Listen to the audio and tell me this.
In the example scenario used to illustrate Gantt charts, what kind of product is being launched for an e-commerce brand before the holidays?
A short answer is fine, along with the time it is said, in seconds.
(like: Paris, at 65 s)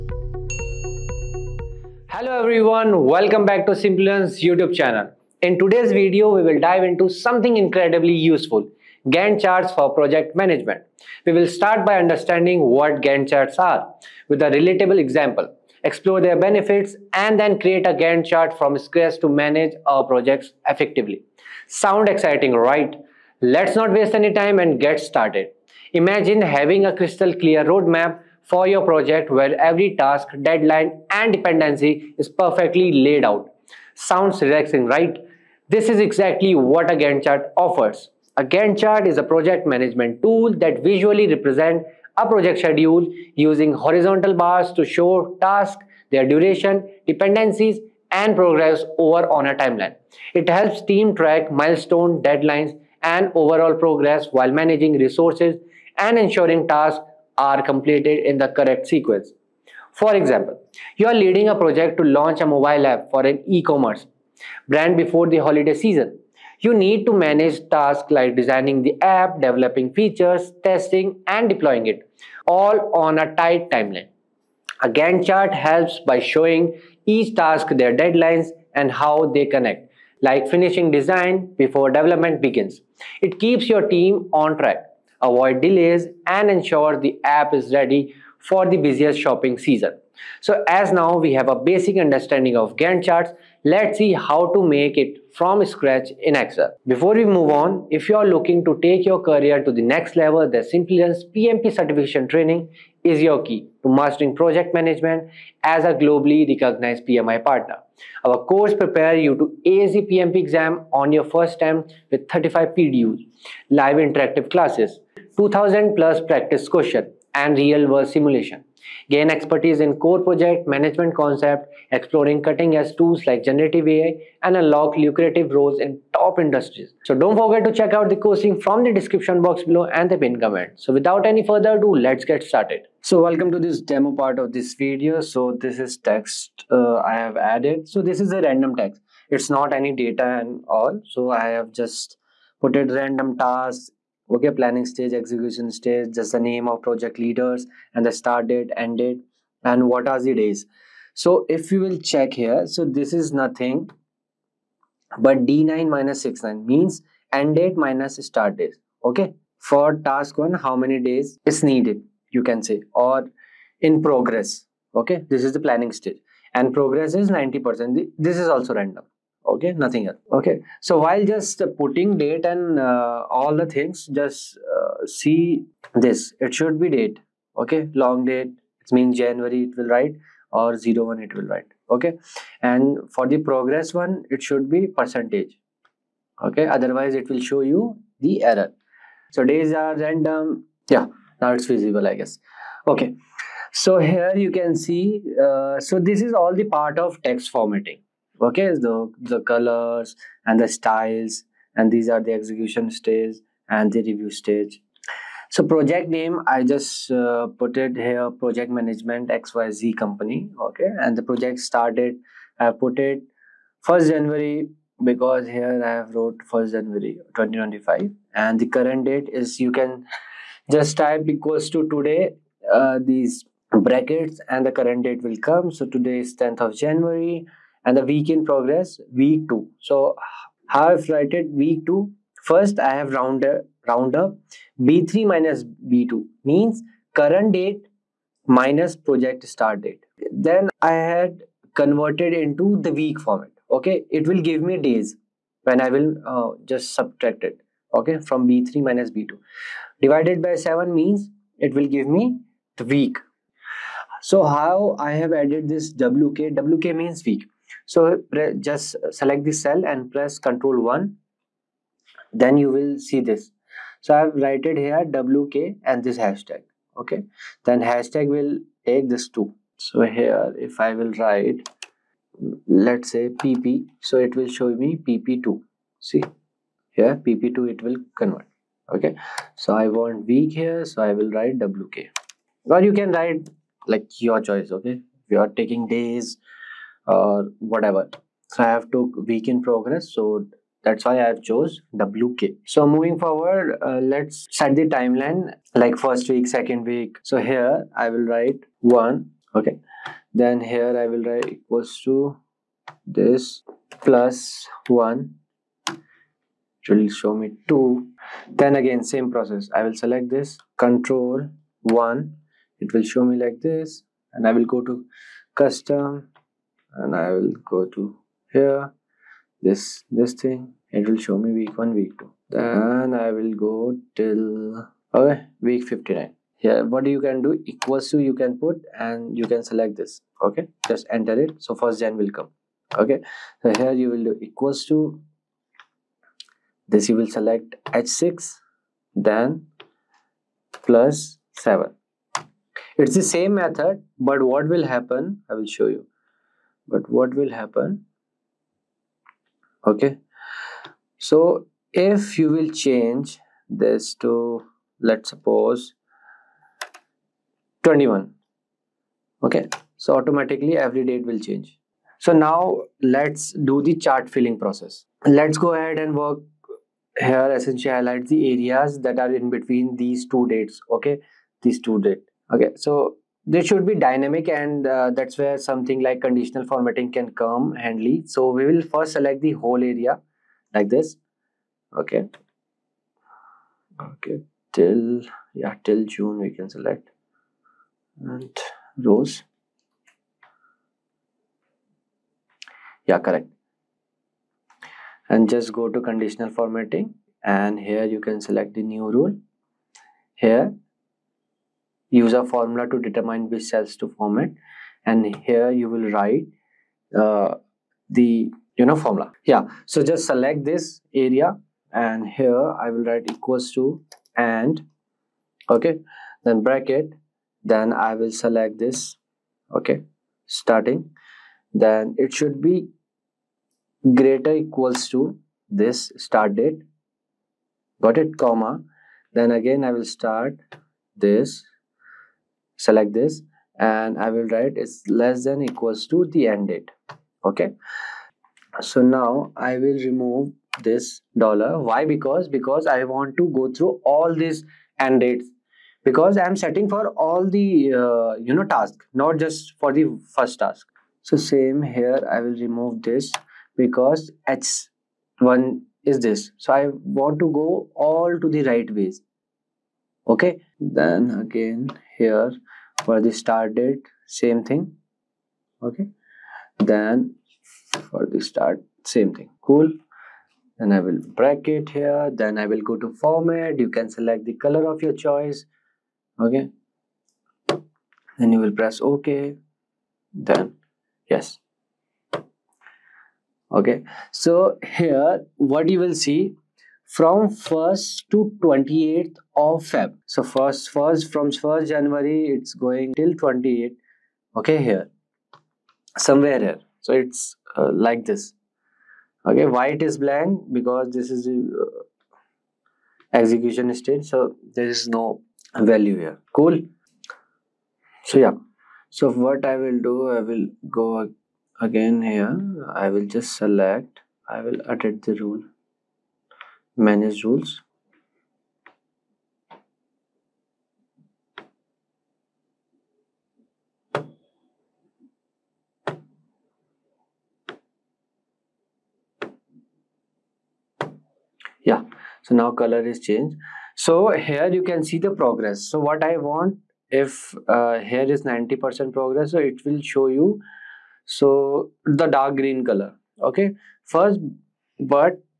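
mobile app, at 62 s.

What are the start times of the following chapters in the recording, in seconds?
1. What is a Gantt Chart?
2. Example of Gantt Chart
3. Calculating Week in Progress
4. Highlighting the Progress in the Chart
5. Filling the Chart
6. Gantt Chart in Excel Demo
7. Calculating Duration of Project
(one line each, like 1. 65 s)
1. 38 s
2. 61 s
3. 213 s
4. 536 s
5. 379 s
6. 91 s
7. 153 s.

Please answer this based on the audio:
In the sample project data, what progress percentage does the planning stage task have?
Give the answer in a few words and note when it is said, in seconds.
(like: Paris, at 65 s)
90%, at 167 s.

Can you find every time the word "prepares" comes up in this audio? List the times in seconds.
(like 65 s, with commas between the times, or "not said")
108 s.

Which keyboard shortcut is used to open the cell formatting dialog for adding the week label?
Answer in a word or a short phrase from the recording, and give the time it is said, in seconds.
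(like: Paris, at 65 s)
Control 1, at 260 s.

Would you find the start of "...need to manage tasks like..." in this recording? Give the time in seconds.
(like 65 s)
66 s.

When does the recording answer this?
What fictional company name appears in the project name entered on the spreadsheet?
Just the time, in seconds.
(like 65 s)
209 s.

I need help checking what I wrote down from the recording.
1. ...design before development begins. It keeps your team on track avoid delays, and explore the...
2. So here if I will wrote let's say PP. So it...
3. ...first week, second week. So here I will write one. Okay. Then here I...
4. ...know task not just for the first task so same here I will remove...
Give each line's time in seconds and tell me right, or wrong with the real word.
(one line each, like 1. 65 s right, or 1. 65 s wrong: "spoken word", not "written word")
1. 80 s wrong: "ensure", not "explore"
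2. 269 s wrong: "write", not "wrote"
3. 295 s right
4. 448 s right.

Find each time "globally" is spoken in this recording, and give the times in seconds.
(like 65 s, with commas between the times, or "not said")
105 s.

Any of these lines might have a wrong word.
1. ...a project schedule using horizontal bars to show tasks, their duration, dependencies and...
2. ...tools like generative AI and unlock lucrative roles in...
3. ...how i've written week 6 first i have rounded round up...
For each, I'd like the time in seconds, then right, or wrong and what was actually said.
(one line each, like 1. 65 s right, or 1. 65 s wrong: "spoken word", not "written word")
1. 42 s right
2. 122 s right
3. 230 s wrong: "2", not "6".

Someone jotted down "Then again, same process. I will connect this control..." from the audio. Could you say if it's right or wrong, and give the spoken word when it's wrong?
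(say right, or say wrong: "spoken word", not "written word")
wrong: "select", not "connect".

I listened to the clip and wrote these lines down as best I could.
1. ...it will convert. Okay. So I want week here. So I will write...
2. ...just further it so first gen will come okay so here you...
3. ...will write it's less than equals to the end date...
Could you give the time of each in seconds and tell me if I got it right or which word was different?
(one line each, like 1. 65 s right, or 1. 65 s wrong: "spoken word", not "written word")
1. 277 s right
2. 330 s wrong: "enter", not "further"
3. 434 s right.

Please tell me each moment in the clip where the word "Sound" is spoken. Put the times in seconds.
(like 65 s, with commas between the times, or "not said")
21 s, 33 s.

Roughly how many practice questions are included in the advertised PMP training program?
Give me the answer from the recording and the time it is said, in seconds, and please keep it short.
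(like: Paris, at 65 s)
2000 plus, at 115 s.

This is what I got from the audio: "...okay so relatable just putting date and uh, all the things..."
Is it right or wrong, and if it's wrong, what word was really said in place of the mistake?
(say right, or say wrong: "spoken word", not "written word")
wrong: "while", not "relatable".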